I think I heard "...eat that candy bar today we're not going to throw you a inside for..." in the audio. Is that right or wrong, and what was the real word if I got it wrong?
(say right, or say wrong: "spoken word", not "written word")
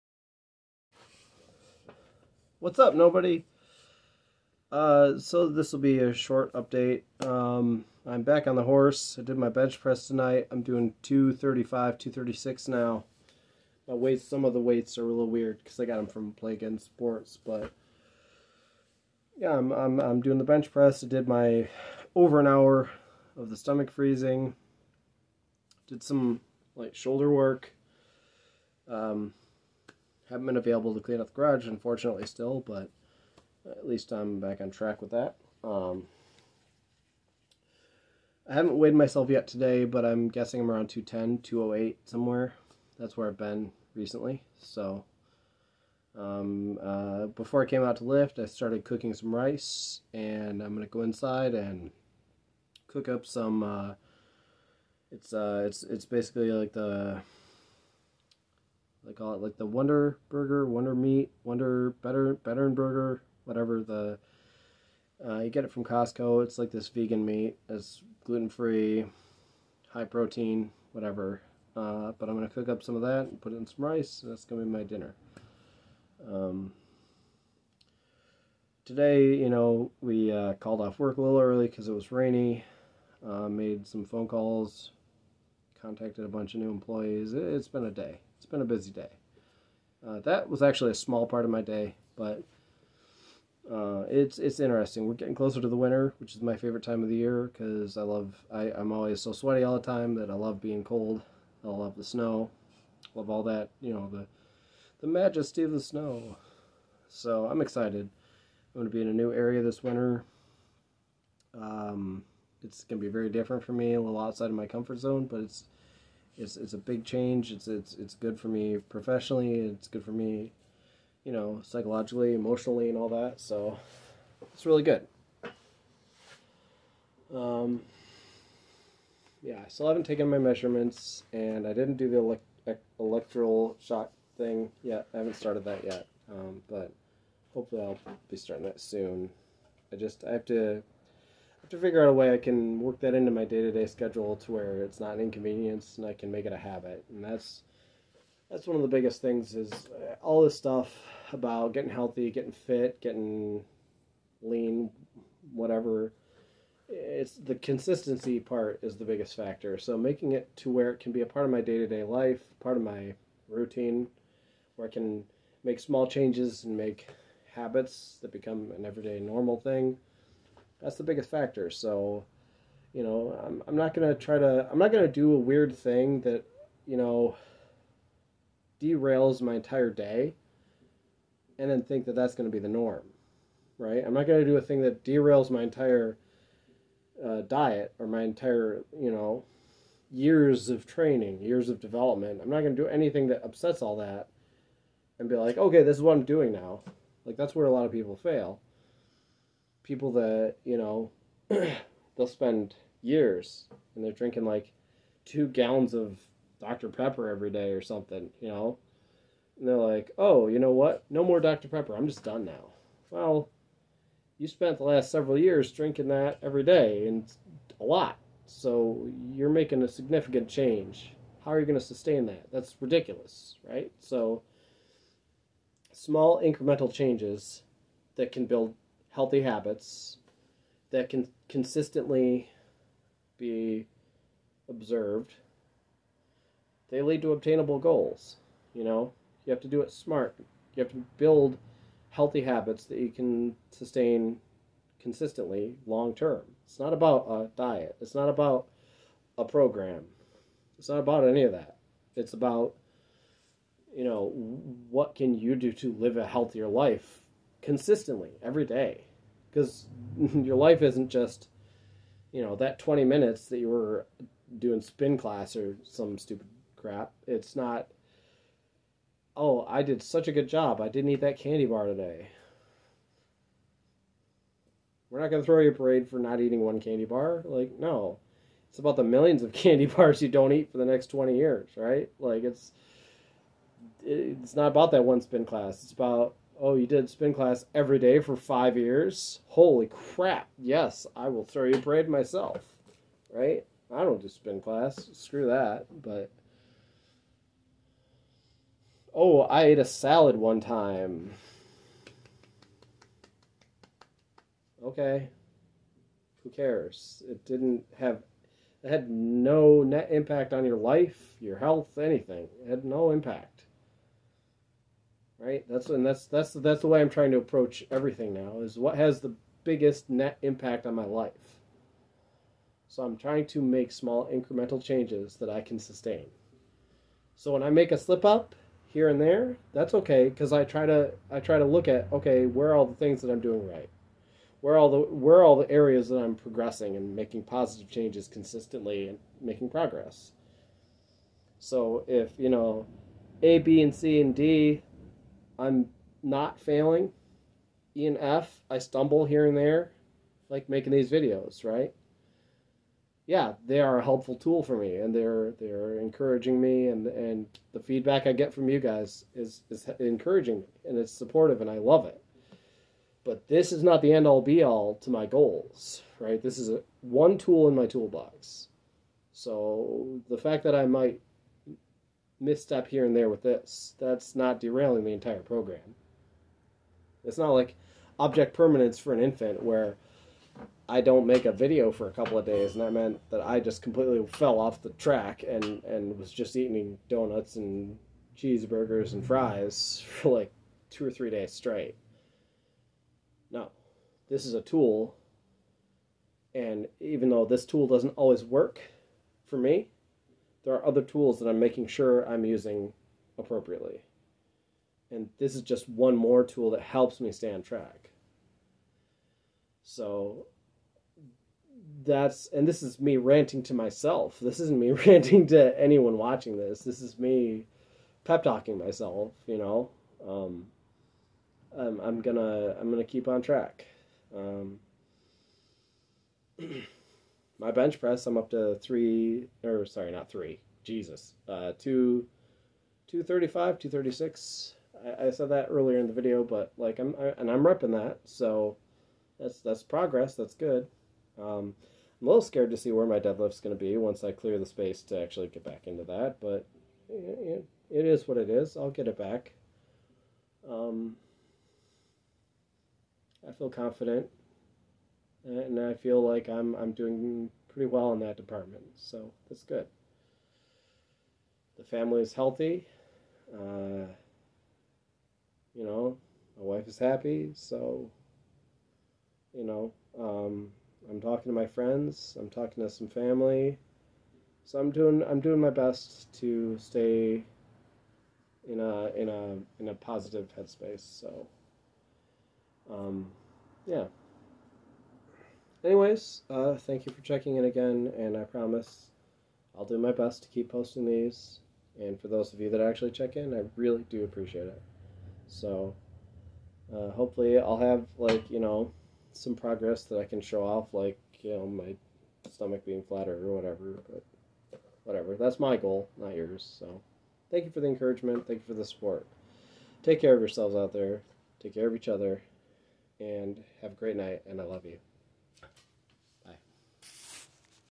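wrong: "parade", not "inside".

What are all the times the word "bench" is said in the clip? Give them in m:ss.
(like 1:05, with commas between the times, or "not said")
0:09, 0:20, 7:07.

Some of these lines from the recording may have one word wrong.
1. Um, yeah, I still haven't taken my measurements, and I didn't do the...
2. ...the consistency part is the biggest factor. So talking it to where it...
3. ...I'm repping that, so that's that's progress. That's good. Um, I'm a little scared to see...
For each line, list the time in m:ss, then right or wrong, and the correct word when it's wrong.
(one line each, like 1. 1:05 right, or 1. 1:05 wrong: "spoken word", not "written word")
1. 2:07 right
2. 2:37 wrong: "making", not "talking"
3. 7:17 right.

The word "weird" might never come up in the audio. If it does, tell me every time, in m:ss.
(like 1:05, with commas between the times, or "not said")
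0:15, 2:55.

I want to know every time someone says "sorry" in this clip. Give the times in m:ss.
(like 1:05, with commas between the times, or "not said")
7:09.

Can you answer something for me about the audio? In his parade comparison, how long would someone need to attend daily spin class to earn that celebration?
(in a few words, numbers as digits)
5 years.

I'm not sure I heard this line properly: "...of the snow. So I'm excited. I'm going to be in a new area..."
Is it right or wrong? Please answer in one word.
right.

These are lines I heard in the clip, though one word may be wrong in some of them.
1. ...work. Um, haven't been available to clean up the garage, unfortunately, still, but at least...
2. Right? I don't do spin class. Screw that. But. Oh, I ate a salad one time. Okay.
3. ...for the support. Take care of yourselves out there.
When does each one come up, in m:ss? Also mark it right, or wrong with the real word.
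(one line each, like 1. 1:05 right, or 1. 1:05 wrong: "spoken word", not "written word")
1. 0:27 right
2. 4:53 right
3. 8:28 right.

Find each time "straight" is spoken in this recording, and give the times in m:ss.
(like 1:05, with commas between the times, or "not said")
6:31.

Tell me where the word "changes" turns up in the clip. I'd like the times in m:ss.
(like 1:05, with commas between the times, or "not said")
1:57, 2:46, 3:40, 3:46, 5:24, 5:37.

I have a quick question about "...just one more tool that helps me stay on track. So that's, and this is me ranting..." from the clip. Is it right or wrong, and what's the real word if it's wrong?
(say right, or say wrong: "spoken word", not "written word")
right.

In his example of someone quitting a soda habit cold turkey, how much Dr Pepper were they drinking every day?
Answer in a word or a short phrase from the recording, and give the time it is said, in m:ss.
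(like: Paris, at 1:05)
2 gallons, at 3:25.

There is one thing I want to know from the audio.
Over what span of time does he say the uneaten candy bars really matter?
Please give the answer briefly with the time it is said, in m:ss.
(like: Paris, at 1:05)
20 years, at 4:41.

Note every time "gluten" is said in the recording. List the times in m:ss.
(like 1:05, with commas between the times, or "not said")
1:08.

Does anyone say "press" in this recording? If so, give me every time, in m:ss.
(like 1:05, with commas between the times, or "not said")
0:09, 0:20, 7:08.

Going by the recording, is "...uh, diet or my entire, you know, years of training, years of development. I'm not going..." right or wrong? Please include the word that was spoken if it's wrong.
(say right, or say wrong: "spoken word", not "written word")
right.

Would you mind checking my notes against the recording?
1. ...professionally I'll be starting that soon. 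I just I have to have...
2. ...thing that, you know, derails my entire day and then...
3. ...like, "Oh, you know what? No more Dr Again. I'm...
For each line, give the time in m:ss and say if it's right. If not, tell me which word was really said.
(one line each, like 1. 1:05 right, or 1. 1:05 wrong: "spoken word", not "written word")
1. 2:17 wrong: "hopefully", not "professionally"
2. 2:55 right
3. 3:29 wrong: "Pepper", not "Again".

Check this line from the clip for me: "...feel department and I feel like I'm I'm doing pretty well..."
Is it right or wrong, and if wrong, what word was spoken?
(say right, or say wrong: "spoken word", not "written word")
wrong: "confident", not "department".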